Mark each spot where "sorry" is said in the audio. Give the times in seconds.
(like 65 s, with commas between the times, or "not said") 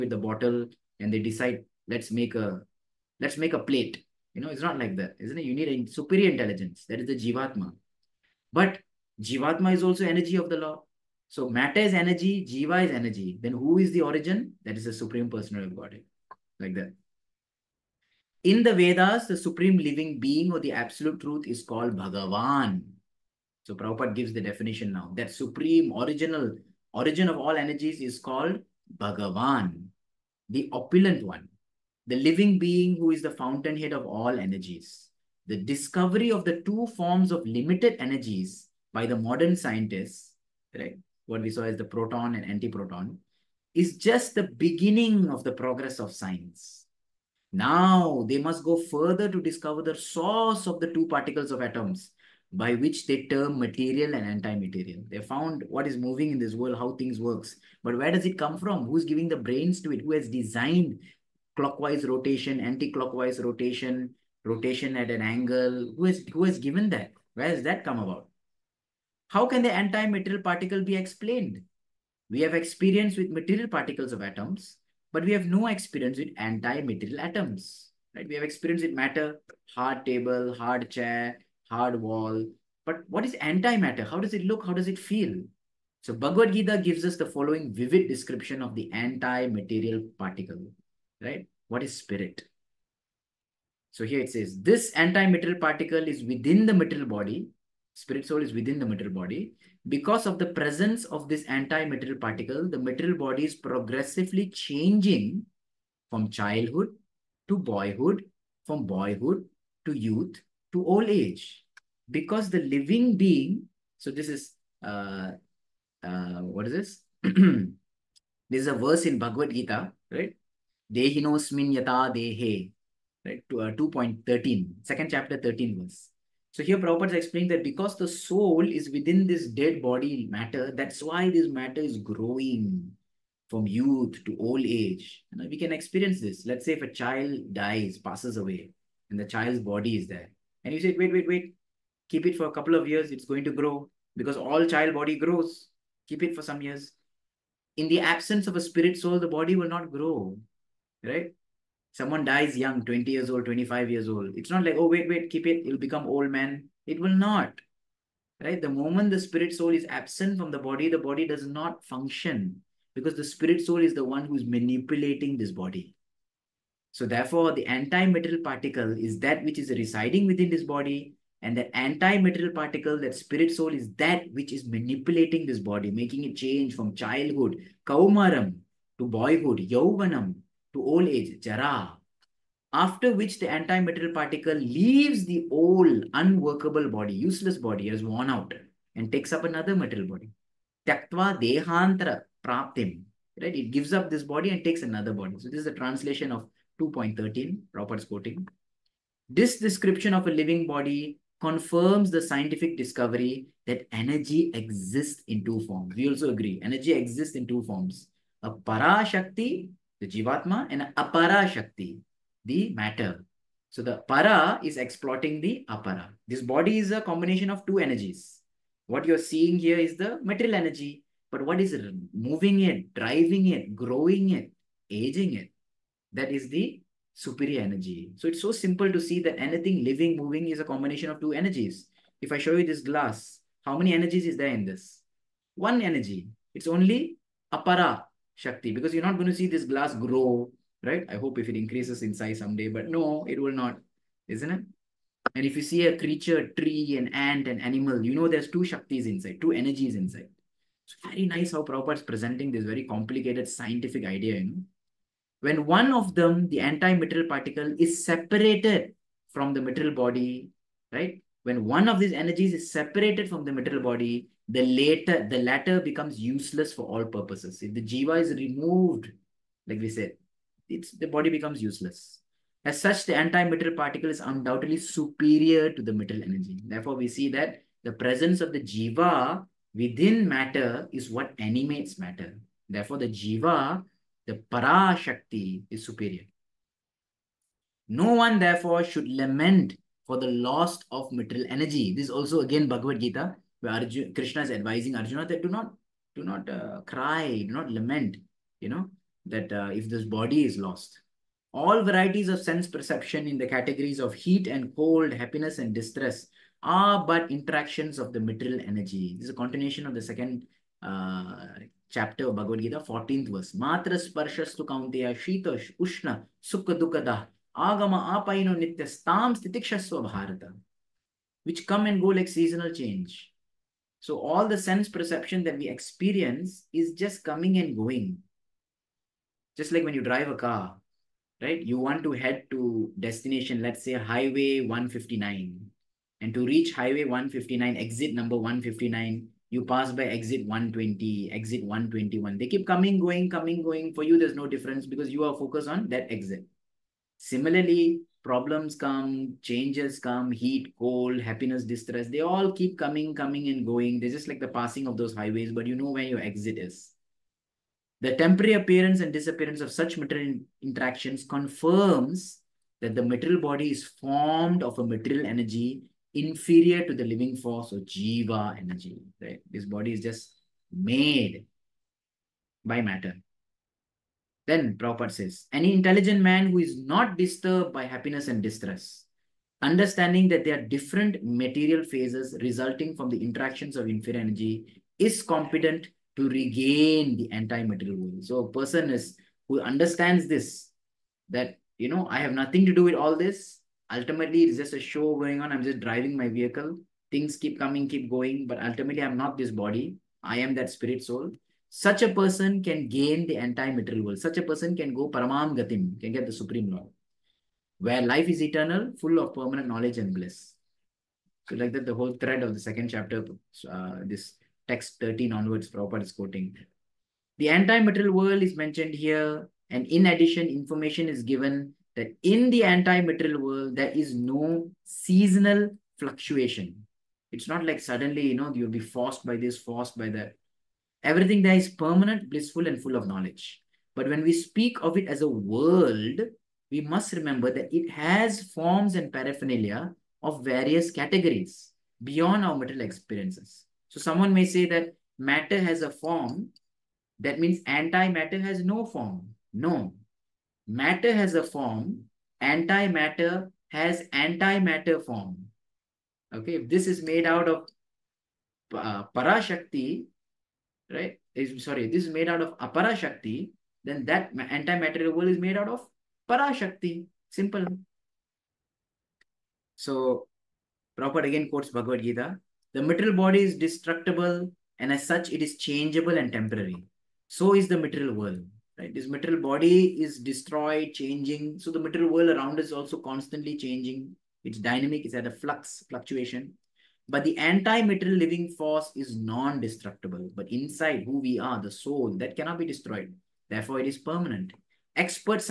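461 s.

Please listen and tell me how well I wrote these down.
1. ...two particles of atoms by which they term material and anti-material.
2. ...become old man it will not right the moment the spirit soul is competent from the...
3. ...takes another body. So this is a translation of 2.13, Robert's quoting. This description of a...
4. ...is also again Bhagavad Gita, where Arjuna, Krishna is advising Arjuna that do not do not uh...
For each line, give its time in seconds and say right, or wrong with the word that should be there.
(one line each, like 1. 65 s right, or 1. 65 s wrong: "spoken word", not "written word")
1. 50 s right
2. 155 s wrong: "absent", not "competent"
3. 194 s right
4. 292 s right.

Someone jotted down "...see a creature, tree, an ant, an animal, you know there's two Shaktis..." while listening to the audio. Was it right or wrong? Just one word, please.
right.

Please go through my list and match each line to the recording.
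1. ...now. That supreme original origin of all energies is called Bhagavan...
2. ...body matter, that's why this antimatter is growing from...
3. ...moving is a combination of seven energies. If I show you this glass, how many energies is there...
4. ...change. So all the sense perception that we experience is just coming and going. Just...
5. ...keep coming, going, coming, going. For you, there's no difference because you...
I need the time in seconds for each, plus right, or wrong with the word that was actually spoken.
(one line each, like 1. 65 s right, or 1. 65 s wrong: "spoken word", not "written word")
1. 24 s right
2. 129 s wrong: "matter", not "antimatter"
3. 230 s wrong: "two", not "seven"
4. 322 s right
5. 342 s right.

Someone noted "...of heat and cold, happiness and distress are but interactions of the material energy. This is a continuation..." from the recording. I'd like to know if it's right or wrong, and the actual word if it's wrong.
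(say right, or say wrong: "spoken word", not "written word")
right.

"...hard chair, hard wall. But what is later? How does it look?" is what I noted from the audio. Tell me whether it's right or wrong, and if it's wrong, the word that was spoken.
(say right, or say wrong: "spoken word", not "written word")
wrong: "antimatter", not "later".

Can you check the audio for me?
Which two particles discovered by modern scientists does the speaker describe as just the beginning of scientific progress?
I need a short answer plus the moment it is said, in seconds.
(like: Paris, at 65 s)
proton and antiproton, at 41 s.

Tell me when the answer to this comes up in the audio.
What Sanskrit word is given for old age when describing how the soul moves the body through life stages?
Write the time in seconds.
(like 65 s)
181 s.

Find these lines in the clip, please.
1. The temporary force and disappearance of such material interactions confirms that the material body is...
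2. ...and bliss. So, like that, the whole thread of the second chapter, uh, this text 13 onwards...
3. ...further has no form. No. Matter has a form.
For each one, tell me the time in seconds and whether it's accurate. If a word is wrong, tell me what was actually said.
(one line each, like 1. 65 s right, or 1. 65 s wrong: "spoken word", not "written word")
1. 358 s wrong: "appearance", not "force"
2. 409 s right
3. 447 s wrong: "antimatter", not "further".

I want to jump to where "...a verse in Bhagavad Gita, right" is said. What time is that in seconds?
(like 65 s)
118 s.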